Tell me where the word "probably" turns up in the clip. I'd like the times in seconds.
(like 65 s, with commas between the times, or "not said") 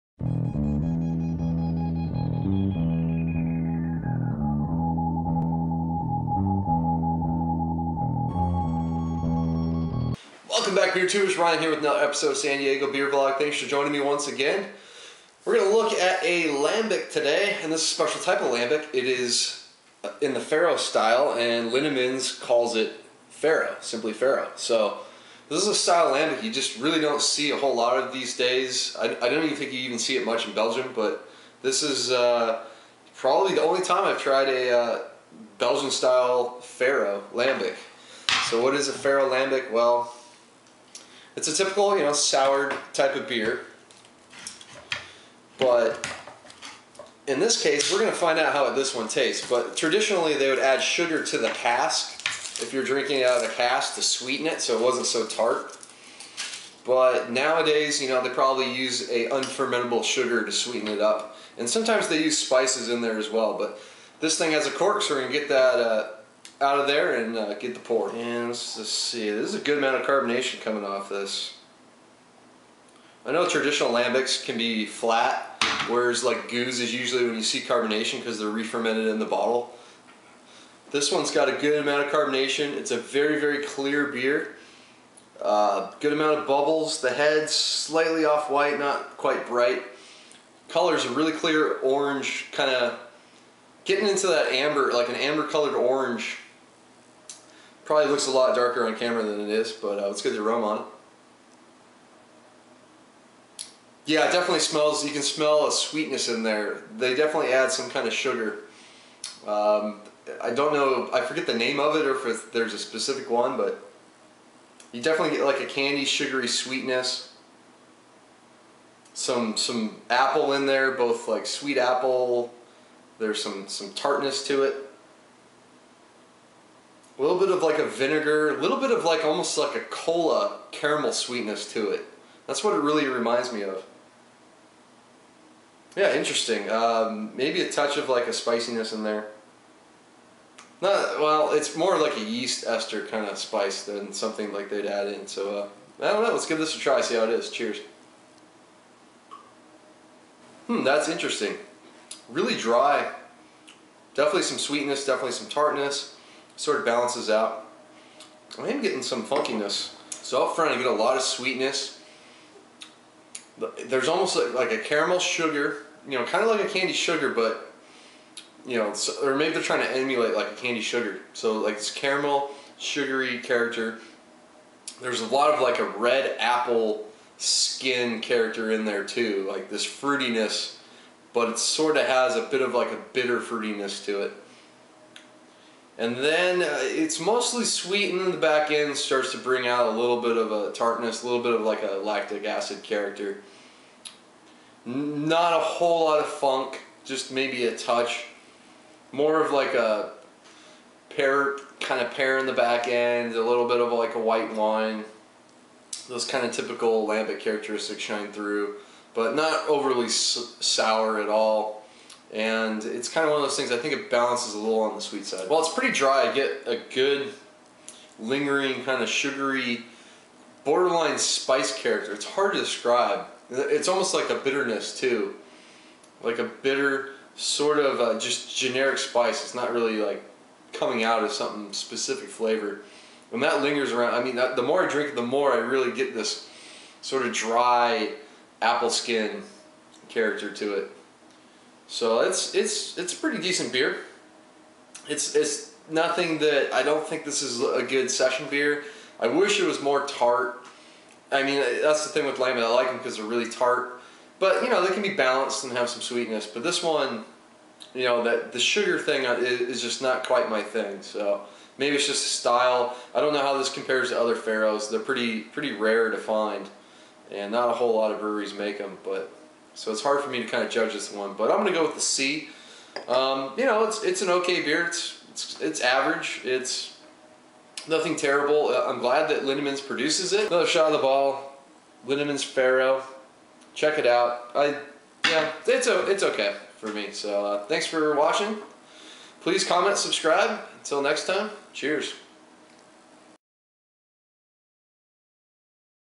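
33 s, 58 s, 97 s.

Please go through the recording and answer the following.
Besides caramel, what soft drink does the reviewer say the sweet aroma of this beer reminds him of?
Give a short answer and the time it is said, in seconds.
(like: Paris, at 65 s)
Cola, at 129 s.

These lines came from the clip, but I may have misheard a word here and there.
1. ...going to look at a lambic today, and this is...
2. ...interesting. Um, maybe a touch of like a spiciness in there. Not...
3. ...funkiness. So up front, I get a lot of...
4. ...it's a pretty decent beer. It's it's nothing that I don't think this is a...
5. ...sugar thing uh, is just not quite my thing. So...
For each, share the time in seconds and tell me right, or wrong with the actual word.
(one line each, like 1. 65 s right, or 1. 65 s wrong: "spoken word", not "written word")
1. 15 s right
2. 136 s right
3. 159 s right
4. 242 s right
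5. 258 s right.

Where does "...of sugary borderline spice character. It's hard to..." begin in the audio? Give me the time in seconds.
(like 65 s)
219 s.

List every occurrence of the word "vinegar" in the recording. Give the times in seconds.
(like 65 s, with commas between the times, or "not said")
127 s.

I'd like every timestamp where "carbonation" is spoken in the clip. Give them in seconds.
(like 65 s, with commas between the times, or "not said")
70 s, 77 s, 82 s.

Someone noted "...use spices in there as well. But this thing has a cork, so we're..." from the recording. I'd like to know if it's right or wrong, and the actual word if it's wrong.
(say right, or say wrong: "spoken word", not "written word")
right.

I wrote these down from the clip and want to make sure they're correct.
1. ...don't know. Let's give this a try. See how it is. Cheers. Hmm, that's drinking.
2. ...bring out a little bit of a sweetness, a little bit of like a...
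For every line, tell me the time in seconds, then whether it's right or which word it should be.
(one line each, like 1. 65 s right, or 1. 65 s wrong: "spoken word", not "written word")
1. 146 s wrong: "interesting", not "drinking"
2. 189 s wrong: "tartness", not "sweetness".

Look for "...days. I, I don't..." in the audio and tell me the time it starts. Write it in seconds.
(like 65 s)
28 s.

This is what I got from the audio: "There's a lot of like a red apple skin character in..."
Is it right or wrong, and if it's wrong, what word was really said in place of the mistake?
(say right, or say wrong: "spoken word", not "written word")
right.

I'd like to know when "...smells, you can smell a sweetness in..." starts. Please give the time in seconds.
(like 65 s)
104 s.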